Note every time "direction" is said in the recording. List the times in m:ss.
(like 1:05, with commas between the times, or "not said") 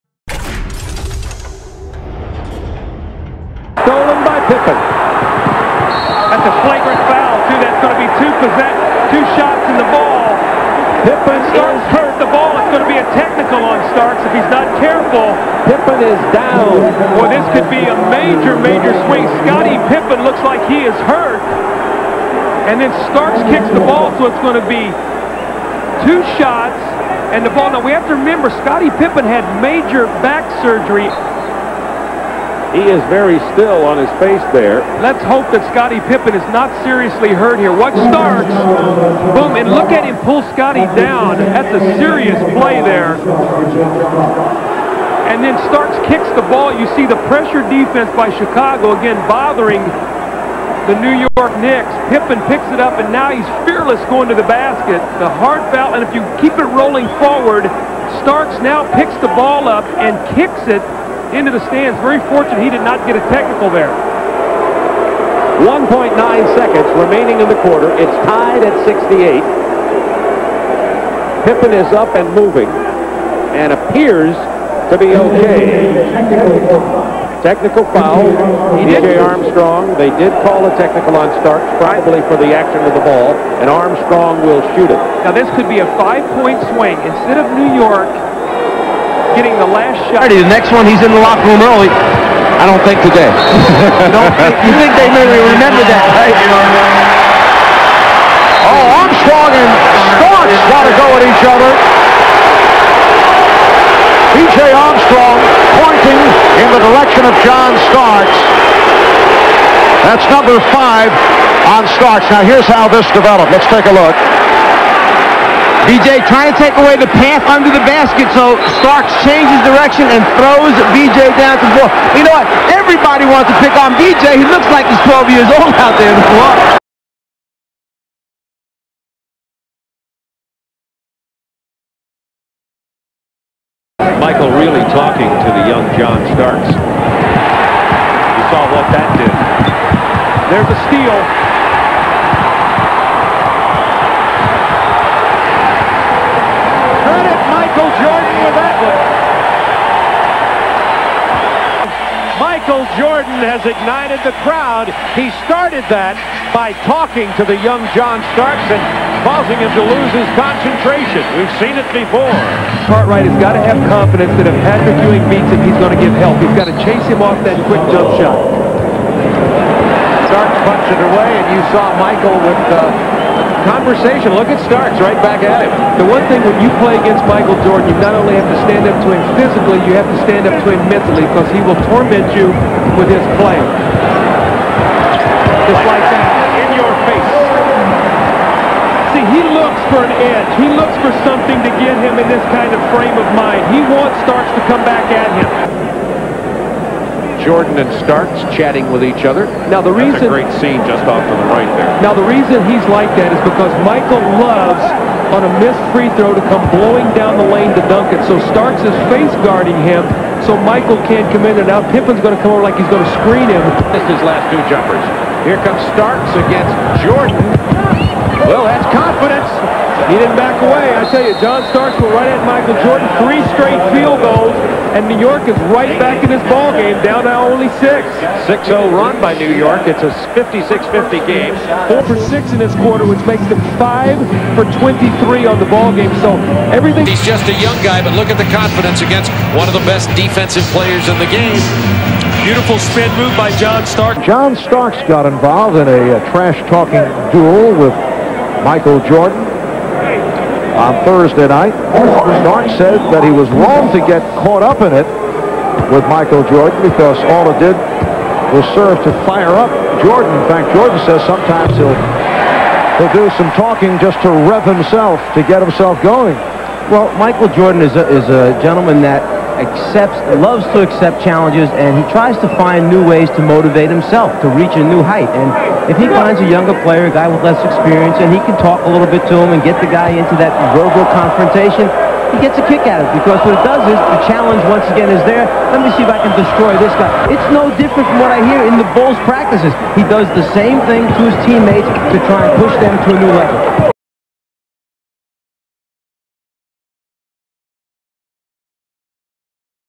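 1:46, 1:59.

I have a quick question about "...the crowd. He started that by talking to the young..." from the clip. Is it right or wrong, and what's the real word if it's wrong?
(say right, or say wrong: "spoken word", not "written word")
right.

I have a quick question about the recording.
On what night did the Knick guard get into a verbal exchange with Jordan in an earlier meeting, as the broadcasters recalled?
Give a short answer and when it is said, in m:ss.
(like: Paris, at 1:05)
Thursday, at 4:11.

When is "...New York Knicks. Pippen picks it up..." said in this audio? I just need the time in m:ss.
0:50.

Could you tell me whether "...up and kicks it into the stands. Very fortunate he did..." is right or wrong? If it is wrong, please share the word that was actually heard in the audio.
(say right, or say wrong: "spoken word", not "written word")
right.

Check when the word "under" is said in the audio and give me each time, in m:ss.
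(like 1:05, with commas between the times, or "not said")
1:57.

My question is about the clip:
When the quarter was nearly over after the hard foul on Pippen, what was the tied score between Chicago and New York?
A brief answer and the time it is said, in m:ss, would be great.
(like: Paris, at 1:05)
68, at 1:07.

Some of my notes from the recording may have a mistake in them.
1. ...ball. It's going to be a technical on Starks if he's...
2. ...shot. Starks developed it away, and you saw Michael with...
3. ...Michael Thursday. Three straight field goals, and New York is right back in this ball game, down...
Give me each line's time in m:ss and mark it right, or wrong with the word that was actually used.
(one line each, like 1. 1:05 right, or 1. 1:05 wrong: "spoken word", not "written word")
1. 0:12 right
2. 2:48 wrong: "punched", not "developed"
3. 3:42 wrong: "Jordan", not "Thursday".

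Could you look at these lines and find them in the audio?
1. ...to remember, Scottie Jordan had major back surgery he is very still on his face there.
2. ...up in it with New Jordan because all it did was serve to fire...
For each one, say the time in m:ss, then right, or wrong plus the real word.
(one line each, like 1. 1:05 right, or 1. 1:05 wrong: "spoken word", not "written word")
1. 0:28 wrong: "Pippen", not "Jordan"
2. 4:14 wrong: "Michael", not "New".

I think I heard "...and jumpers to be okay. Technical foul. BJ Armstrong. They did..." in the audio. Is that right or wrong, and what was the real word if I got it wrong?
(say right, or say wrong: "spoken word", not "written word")
wrong: "appears", not "jumpers".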